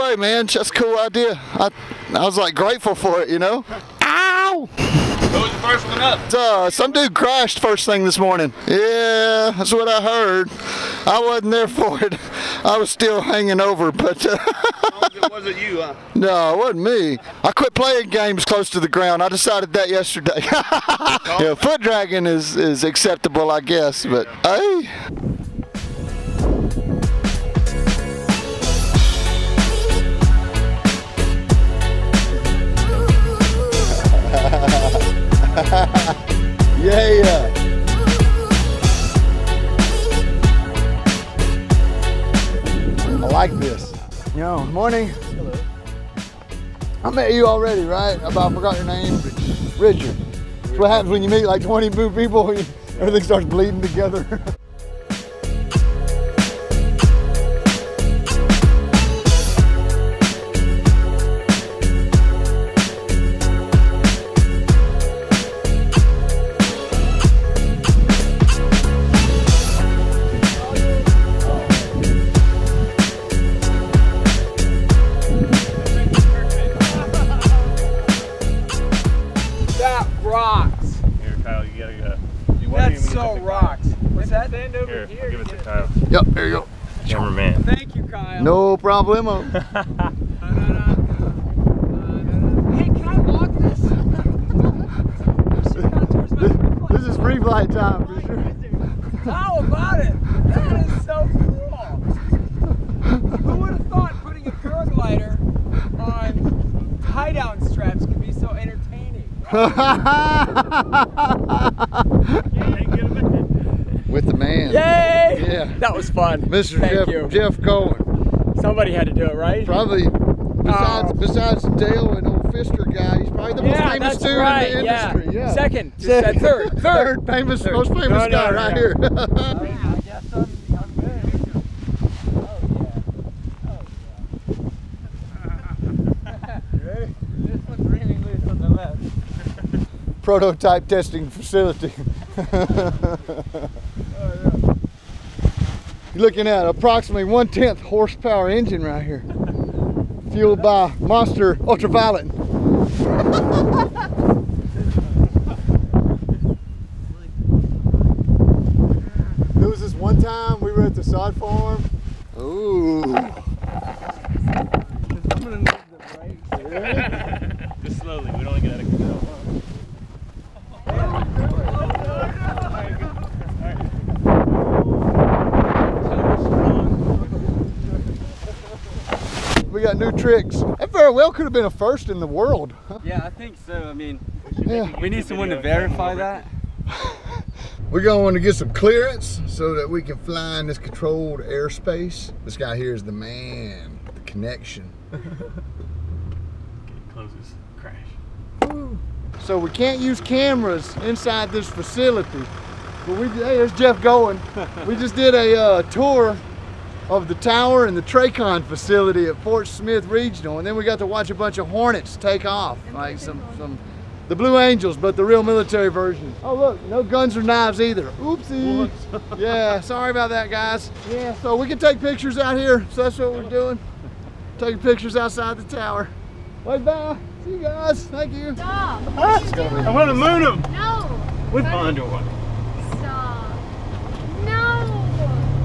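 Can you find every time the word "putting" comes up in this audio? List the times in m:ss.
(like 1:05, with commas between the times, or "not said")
1:44.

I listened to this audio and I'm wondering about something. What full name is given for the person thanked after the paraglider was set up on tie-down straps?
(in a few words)
Jeff Goin.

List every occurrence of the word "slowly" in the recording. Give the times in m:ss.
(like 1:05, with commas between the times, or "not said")
2:48.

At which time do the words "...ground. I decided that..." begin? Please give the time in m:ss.
0:18.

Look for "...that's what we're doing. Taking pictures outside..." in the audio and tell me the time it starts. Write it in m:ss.
3:43.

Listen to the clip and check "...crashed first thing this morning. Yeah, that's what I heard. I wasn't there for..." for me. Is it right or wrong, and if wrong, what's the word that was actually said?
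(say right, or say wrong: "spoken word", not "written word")
right.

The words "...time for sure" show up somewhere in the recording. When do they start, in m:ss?
1:37.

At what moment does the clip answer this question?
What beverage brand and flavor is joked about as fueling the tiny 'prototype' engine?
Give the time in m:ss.
2:30.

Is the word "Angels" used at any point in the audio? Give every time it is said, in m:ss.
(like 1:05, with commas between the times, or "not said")
3:34.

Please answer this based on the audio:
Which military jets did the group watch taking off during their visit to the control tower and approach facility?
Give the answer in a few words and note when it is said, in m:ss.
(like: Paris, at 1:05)
Hornets, at 3:31.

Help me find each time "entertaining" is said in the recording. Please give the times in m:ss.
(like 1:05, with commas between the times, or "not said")
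1:48.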